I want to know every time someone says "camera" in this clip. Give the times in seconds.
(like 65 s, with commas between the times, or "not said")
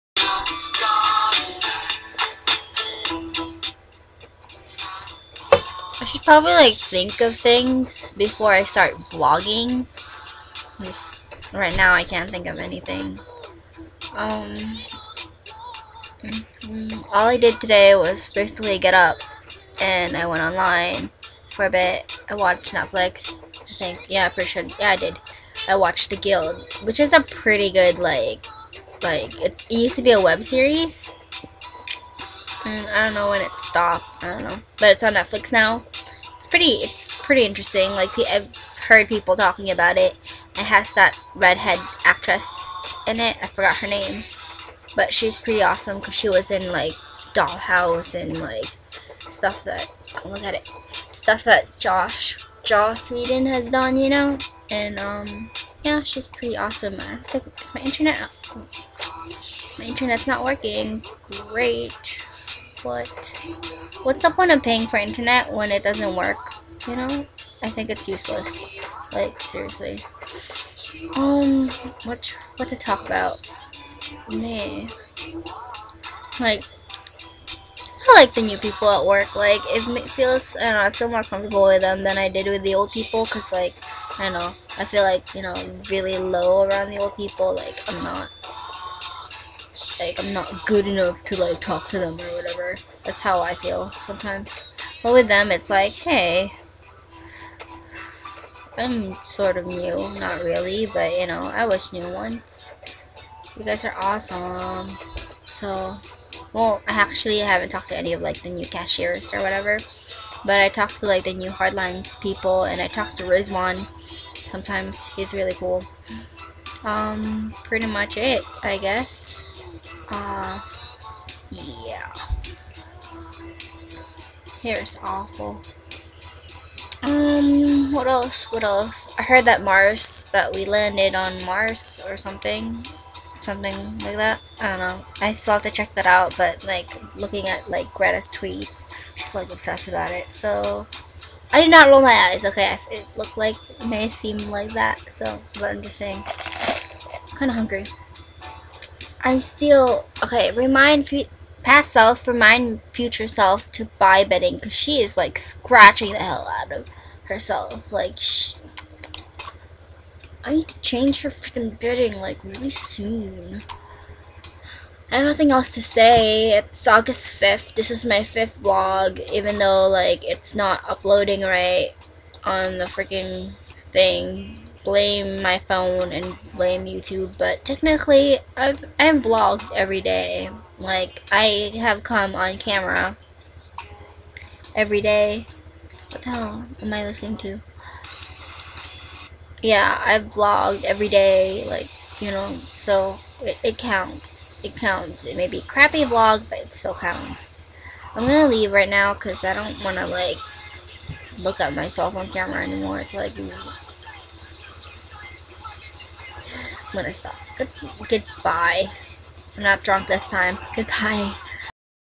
182 s, 202 s.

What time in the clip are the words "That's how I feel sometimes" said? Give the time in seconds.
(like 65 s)
93 s.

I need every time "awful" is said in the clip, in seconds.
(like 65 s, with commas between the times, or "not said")
125 s.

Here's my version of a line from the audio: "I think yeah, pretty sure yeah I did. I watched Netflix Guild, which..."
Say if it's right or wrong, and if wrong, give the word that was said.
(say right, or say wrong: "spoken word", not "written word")
wrong: "The", not "Netflix".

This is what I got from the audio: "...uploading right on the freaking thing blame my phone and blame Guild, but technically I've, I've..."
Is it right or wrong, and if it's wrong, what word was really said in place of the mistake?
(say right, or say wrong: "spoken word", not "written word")
wrong: "YouTube", not "Guild".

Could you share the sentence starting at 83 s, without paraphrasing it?
Because, like, I don't know, I feel like, you know, really low around the old people.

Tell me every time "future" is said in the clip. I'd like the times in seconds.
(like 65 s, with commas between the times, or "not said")
152 s.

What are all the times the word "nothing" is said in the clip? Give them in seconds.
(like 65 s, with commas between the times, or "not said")
165 s.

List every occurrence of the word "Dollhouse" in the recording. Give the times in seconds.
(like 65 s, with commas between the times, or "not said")
47 s.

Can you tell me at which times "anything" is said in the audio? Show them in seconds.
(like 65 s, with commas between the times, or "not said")
12 s.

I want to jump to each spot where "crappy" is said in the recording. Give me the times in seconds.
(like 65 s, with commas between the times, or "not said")
195 s.